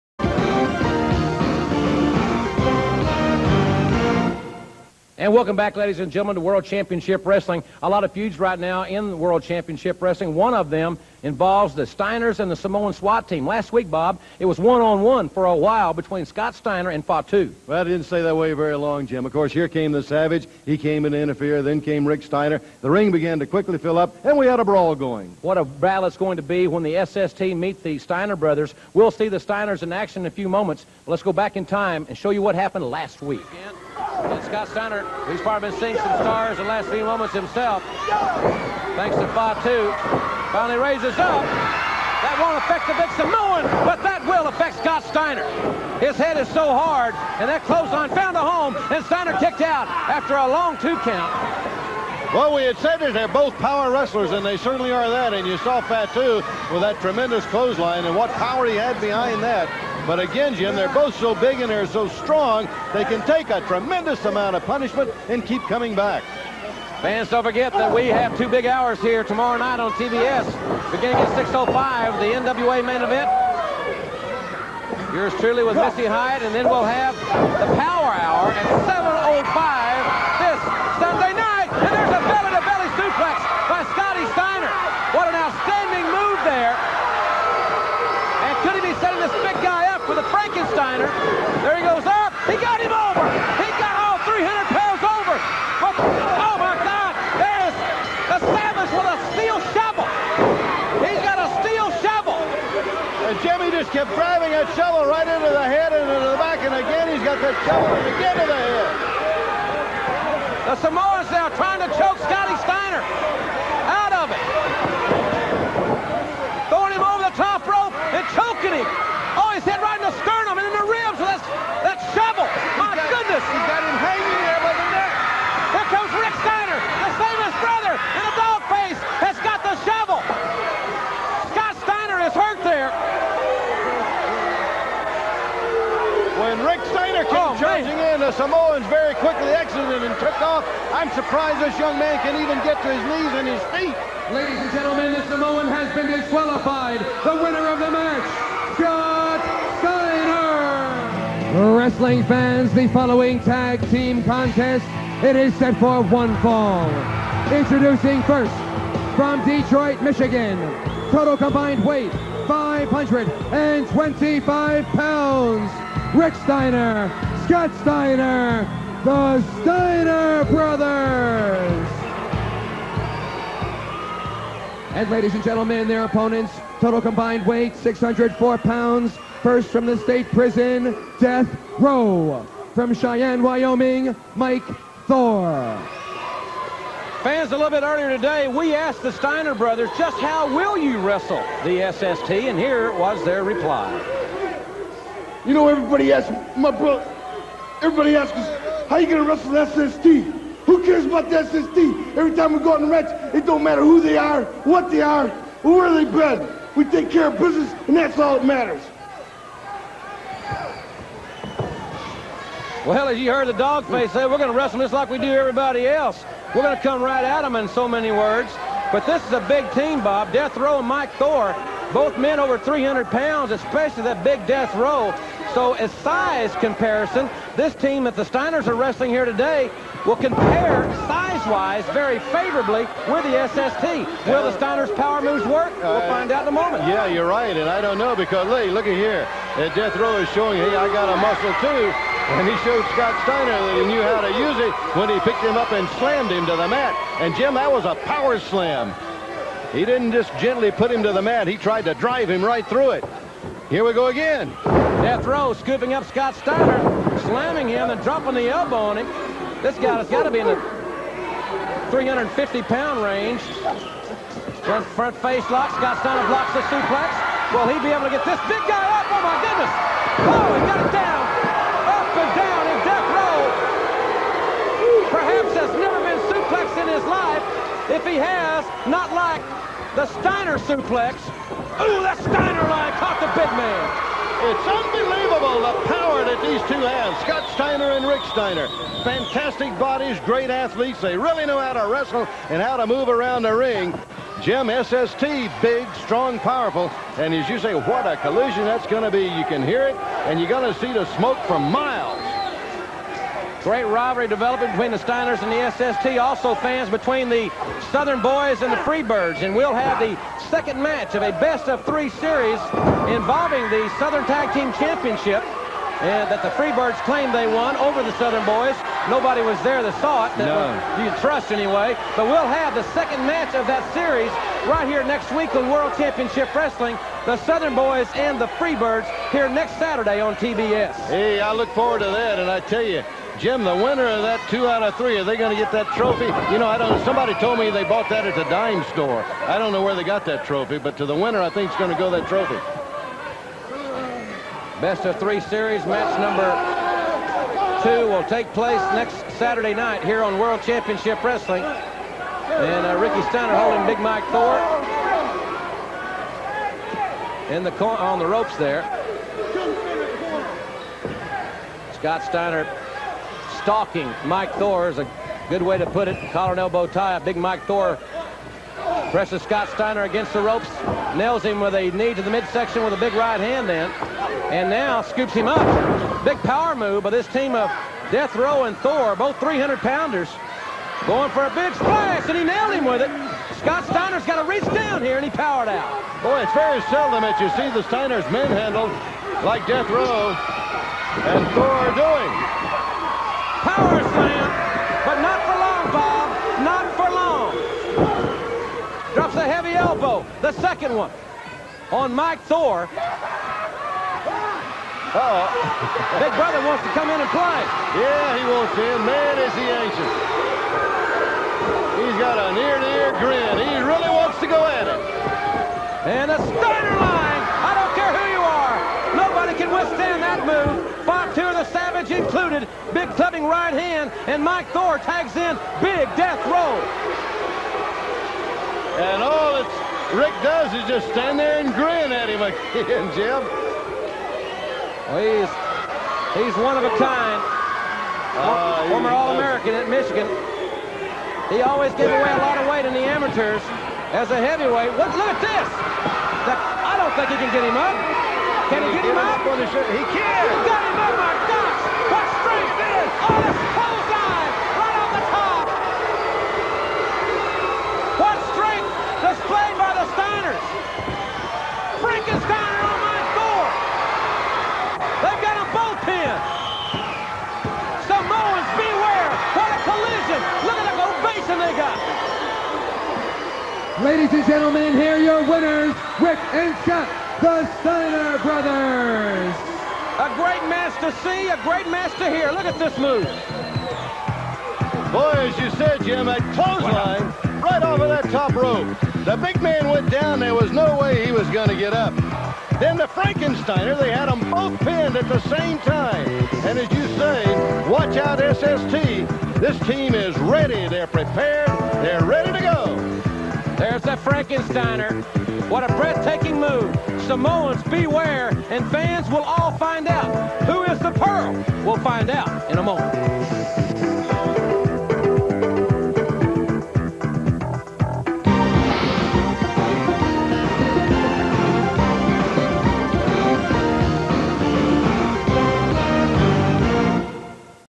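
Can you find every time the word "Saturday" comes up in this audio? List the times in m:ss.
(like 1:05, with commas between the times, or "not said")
5:29, 5:49.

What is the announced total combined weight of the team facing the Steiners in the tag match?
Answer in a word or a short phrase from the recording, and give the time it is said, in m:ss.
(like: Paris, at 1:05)
604 pounds, at 2:57.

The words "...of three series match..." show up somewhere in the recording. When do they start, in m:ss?
5:45.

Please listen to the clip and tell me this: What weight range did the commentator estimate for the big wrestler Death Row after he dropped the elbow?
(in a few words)
350-pound range.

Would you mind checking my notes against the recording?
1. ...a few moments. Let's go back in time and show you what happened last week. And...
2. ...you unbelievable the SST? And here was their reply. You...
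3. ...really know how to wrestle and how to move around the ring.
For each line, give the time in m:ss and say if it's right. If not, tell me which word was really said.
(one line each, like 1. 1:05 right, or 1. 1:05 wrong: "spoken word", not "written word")
1. 0:30 right
2. 3:10 wrong: "wrestle", not "unbelievable"
3. 4:51 right.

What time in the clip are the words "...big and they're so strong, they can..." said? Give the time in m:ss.
1:01.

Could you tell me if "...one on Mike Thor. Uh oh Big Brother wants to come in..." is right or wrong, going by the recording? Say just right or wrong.
right.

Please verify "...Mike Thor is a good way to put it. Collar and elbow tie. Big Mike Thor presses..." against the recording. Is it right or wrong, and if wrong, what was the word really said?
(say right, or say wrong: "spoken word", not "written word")
right.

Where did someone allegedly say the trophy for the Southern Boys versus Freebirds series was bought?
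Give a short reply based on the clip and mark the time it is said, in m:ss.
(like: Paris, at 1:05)
the dime store, at 5:38.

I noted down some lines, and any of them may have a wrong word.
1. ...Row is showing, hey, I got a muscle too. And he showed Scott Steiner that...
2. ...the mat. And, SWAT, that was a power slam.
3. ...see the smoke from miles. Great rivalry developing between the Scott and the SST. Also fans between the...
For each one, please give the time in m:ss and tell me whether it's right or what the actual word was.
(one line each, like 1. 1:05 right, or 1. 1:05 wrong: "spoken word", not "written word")
1. 3:59 right
2. 4:06 wrong: "Jim", not "SWAT"
3. 5:00 wrong: "Steiners", not "Scott".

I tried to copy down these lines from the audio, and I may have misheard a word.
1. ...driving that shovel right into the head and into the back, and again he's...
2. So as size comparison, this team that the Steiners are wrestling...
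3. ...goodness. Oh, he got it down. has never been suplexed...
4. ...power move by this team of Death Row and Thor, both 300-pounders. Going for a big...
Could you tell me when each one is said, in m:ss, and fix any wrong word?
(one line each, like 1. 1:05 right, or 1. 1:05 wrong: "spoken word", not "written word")
1. 1:44 right
2. 3:45 right
3. 4:29 right
4. 6:16 right.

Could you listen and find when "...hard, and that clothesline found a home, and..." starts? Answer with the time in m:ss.
0:46.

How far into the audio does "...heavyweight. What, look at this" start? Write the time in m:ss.
7:24.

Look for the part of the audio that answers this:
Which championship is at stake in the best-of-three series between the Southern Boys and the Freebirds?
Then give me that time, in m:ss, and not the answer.
5:13.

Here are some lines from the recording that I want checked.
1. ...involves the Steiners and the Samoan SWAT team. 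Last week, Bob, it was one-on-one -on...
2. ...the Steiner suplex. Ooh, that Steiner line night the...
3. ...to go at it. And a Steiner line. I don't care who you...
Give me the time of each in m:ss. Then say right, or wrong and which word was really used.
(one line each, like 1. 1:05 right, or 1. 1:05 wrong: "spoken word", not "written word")
1. 0:11 right
2. 4:39 wrong: "caught", not "night"
3. 6:54 right.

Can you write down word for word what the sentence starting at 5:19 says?
Nobody was there that saw it.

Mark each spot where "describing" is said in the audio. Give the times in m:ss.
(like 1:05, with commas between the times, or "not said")
not said.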